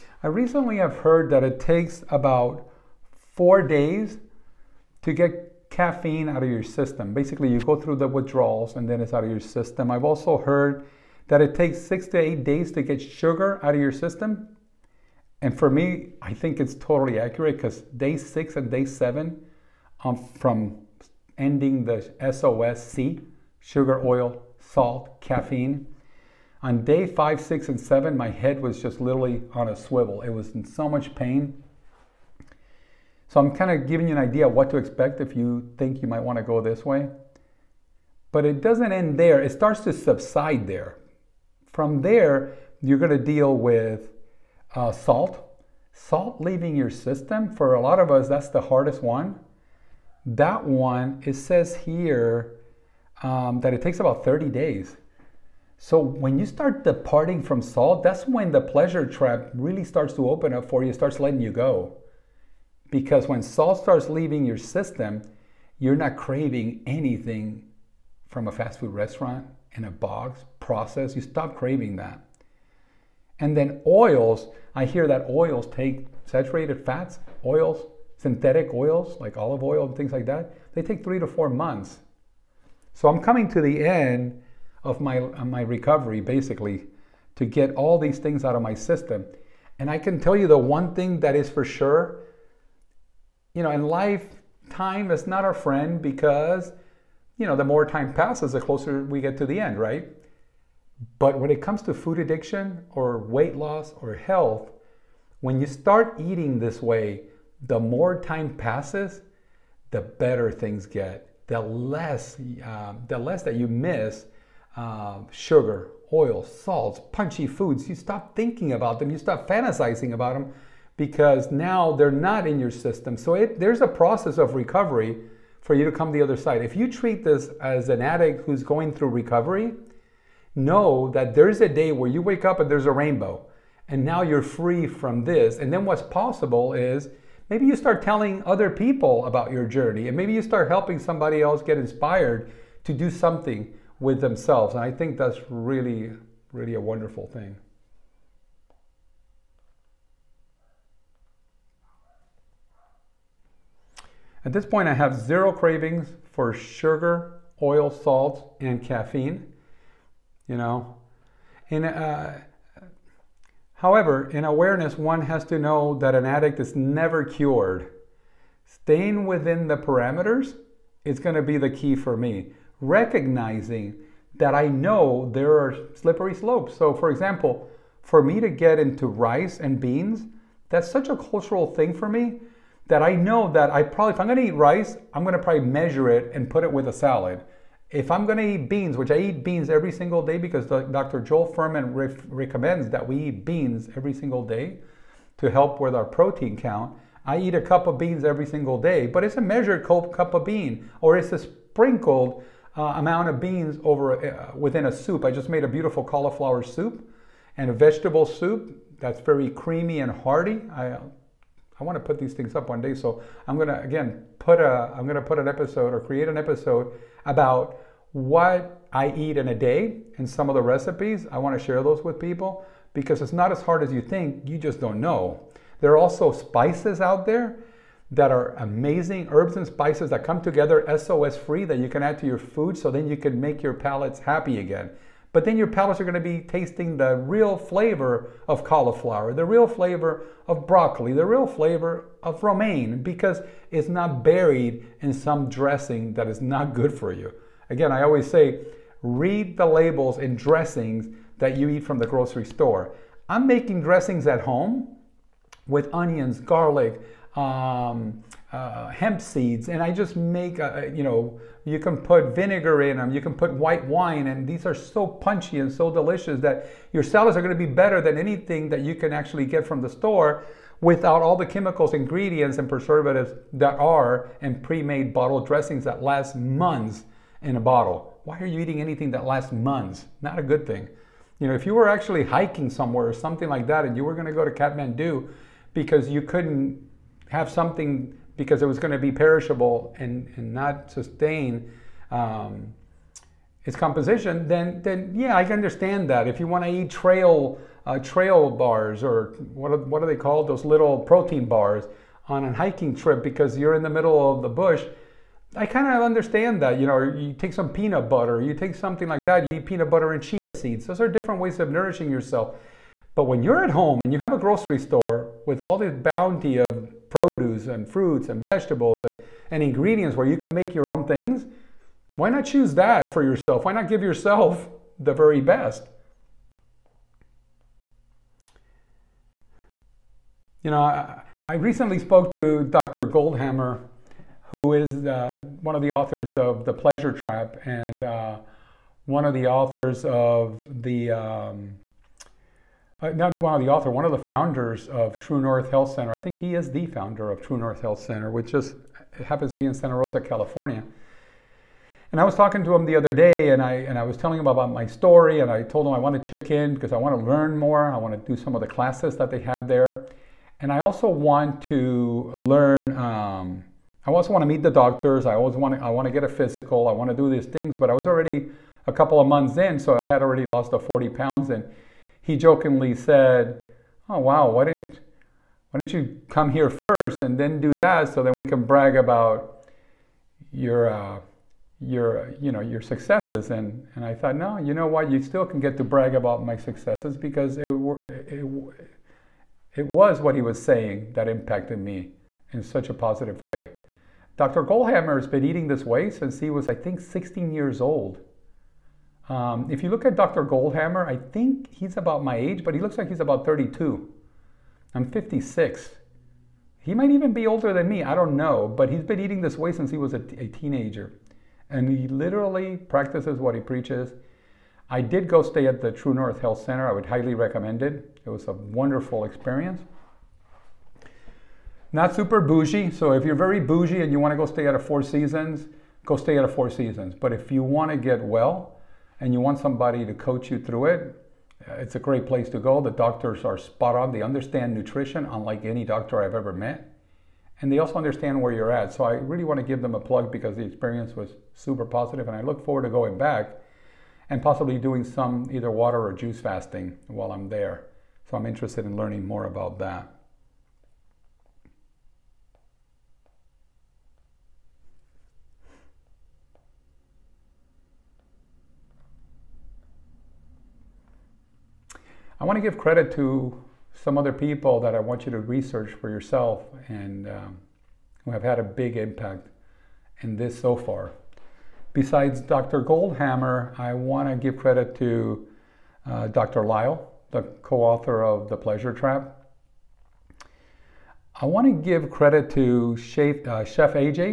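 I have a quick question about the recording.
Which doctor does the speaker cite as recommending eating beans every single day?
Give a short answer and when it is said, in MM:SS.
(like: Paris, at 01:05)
Joel Fuhrman, at 03:11.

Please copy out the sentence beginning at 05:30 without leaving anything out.
You know, I, I recently spoke to Dr.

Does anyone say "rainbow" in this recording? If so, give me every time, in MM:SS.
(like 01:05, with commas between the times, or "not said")
02:12.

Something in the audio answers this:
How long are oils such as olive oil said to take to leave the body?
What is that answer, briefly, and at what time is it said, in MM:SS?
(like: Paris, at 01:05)
3 to 4 months, at 01:21.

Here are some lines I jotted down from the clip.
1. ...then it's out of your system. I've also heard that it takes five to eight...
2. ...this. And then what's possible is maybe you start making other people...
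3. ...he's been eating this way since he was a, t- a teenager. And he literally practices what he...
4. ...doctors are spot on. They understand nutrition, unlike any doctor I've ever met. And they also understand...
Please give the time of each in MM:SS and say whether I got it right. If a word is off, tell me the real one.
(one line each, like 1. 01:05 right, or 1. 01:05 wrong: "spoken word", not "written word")
1. 00:08 wrong: "six", not "five"
2. 02:15 wrong: "telling", not "making"
3. 06:48 right
4. 07:12 right.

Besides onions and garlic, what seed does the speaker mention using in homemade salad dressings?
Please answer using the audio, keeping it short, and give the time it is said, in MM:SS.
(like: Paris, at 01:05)
Hemp seeds, at 04:18.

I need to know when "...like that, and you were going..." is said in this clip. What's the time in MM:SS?
04:43.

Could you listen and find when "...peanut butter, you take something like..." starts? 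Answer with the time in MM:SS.
05:07.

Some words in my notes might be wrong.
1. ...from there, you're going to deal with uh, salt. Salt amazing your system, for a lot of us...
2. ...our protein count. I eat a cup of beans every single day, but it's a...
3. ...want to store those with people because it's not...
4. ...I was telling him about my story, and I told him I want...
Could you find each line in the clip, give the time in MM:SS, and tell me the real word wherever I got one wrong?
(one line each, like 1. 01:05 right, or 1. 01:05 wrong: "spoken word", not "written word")
1. 00:41 wrong: "leaving", not "amazing"
2. 03:15 right
3. 03:41 wrong: "share", not "store"
4. 05:53 right.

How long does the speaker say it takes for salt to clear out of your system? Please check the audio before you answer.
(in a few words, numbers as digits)
30 days.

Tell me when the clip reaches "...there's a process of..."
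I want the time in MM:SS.
02:03.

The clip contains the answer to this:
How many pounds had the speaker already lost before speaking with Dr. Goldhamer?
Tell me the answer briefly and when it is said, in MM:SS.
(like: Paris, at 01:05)
40 pounds, at 06:10.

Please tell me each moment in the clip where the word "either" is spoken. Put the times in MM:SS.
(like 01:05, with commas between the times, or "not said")
07:25.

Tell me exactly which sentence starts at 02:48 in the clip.
Staying within the parameters is going to be the key for me.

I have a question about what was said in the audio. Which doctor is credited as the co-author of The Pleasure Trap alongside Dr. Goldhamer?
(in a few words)
Dr. Lisle.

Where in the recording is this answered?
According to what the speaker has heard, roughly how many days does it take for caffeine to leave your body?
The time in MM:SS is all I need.
00:03.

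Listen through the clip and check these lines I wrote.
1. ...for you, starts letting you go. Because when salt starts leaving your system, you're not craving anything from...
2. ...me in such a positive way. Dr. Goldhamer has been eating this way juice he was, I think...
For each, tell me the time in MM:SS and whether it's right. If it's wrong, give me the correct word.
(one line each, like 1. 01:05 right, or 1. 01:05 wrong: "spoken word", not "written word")
1. 01:00 right
2. 06:31 wrong: "since", not "juice".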